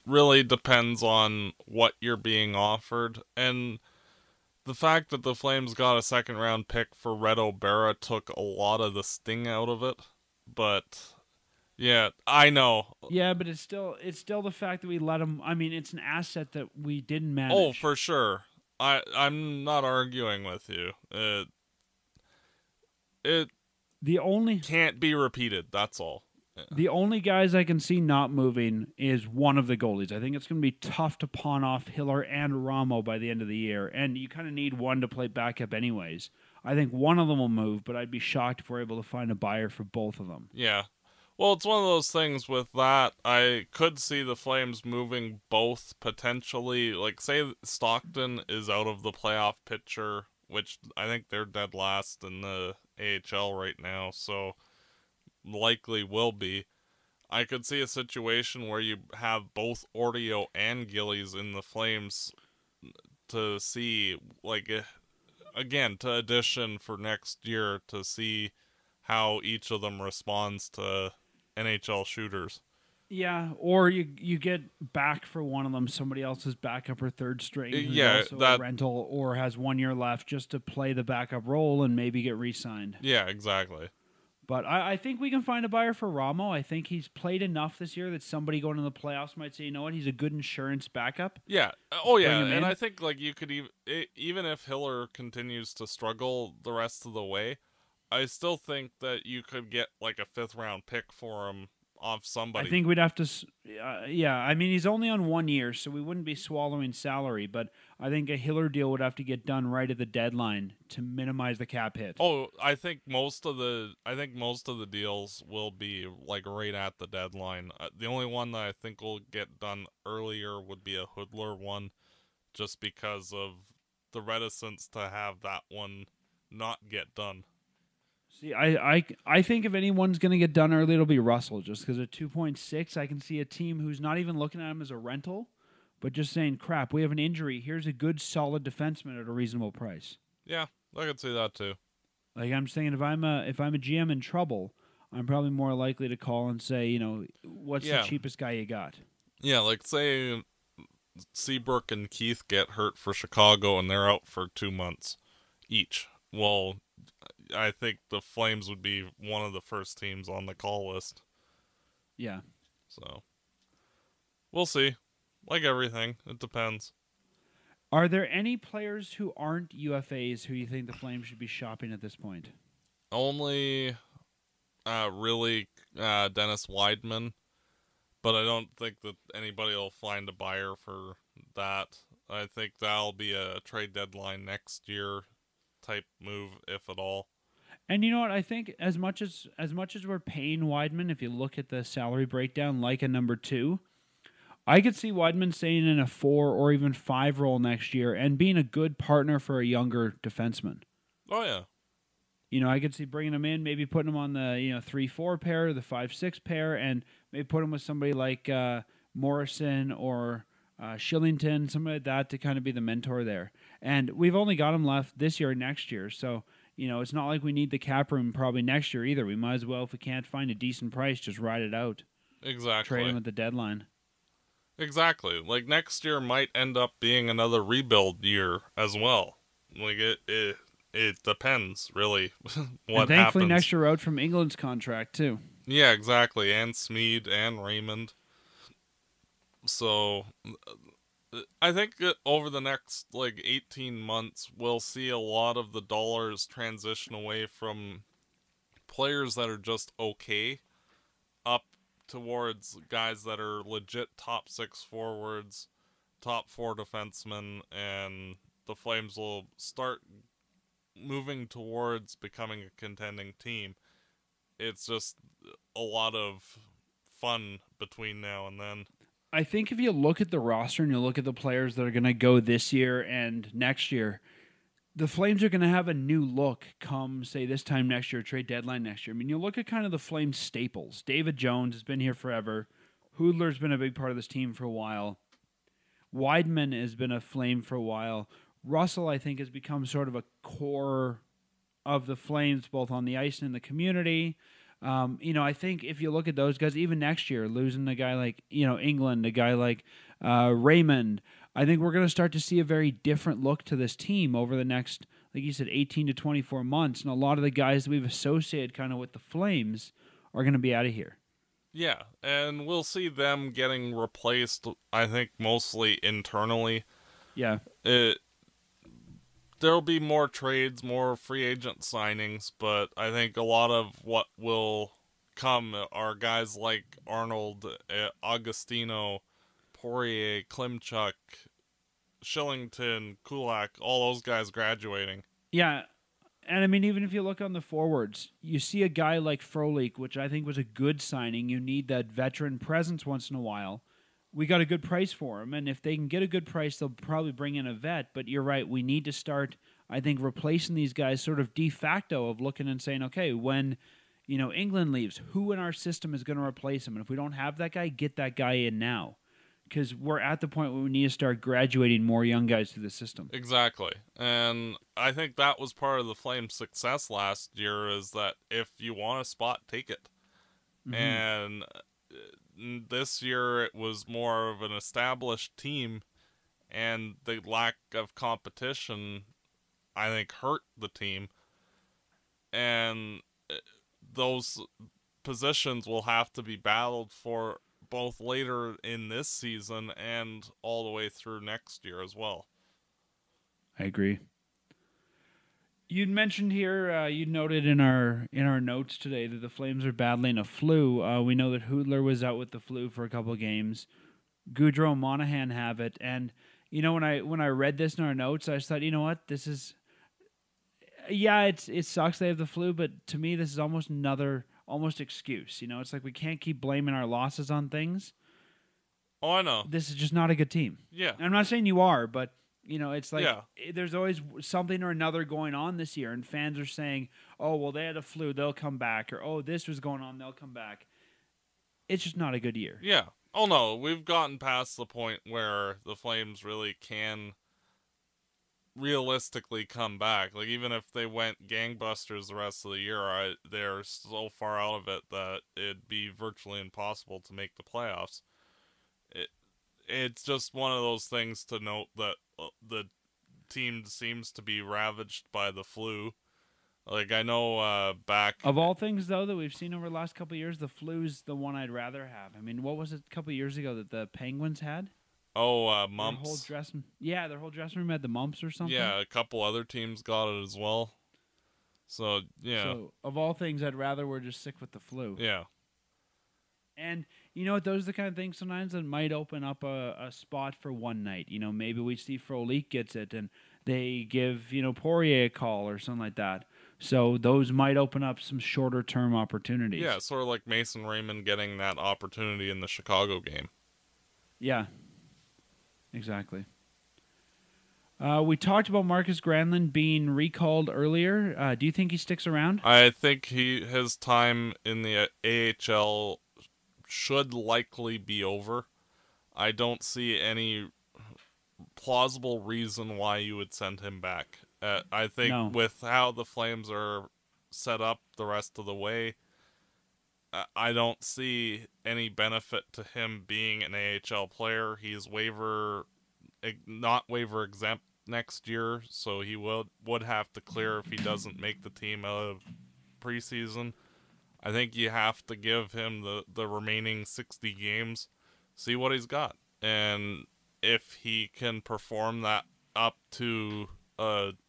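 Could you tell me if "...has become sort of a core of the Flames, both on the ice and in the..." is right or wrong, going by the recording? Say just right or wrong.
right.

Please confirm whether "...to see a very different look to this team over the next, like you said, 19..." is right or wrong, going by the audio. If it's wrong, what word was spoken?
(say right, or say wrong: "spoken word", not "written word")
wrong: "18", not "19".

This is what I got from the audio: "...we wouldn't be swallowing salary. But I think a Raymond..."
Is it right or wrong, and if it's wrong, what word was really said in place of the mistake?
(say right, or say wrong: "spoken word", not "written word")
wrong: "Hiller", not "Raymond".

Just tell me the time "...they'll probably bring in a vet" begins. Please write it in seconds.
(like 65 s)
346 s.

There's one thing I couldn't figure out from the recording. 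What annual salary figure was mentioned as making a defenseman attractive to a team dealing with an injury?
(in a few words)
2.6.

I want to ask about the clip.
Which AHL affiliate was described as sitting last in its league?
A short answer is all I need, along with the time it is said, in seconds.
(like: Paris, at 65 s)
Stockton, at 47 s.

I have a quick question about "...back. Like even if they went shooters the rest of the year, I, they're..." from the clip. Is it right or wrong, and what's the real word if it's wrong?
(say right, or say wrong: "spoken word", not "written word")
wrong: "gangbusters", not "shooters".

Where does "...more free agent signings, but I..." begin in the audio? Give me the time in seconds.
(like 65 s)
320 s.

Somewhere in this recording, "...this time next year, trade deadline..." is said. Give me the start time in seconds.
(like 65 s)
277 s.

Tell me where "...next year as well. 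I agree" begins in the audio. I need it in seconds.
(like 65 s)
391 s.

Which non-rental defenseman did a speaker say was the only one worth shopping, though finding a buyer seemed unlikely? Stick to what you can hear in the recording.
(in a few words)
Dennis Wideman.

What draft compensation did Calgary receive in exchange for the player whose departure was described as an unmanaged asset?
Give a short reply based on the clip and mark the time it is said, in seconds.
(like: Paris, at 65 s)
second round pick, at 6 s.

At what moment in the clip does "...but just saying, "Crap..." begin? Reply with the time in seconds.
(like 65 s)
136 s.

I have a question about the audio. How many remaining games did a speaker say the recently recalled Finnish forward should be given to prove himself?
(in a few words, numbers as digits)
60.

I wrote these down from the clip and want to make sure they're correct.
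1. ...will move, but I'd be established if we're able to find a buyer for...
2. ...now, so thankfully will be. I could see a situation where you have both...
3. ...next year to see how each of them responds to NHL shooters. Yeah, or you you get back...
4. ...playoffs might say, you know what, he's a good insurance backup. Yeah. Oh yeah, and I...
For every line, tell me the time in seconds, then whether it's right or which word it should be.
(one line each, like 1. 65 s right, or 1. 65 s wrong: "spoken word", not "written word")
1. 37 s wrong: "shocked", not "established"
2. 53 s wrong: "likely", not "thankfully"
3. 66 s right
4. 88 s right.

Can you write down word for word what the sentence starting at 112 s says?
Oh, I think most of the, I think most of the deals will be like right at the deadline.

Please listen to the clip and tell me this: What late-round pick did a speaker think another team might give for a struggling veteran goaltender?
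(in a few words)
fifth round pick.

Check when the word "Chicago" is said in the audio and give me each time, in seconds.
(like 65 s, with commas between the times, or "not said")
153 s, 492 s.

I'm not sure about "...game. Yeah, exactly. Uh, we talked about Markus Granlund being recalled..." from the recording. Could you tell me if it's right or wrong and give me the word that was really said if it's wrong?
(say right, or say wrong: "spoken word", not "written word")
right.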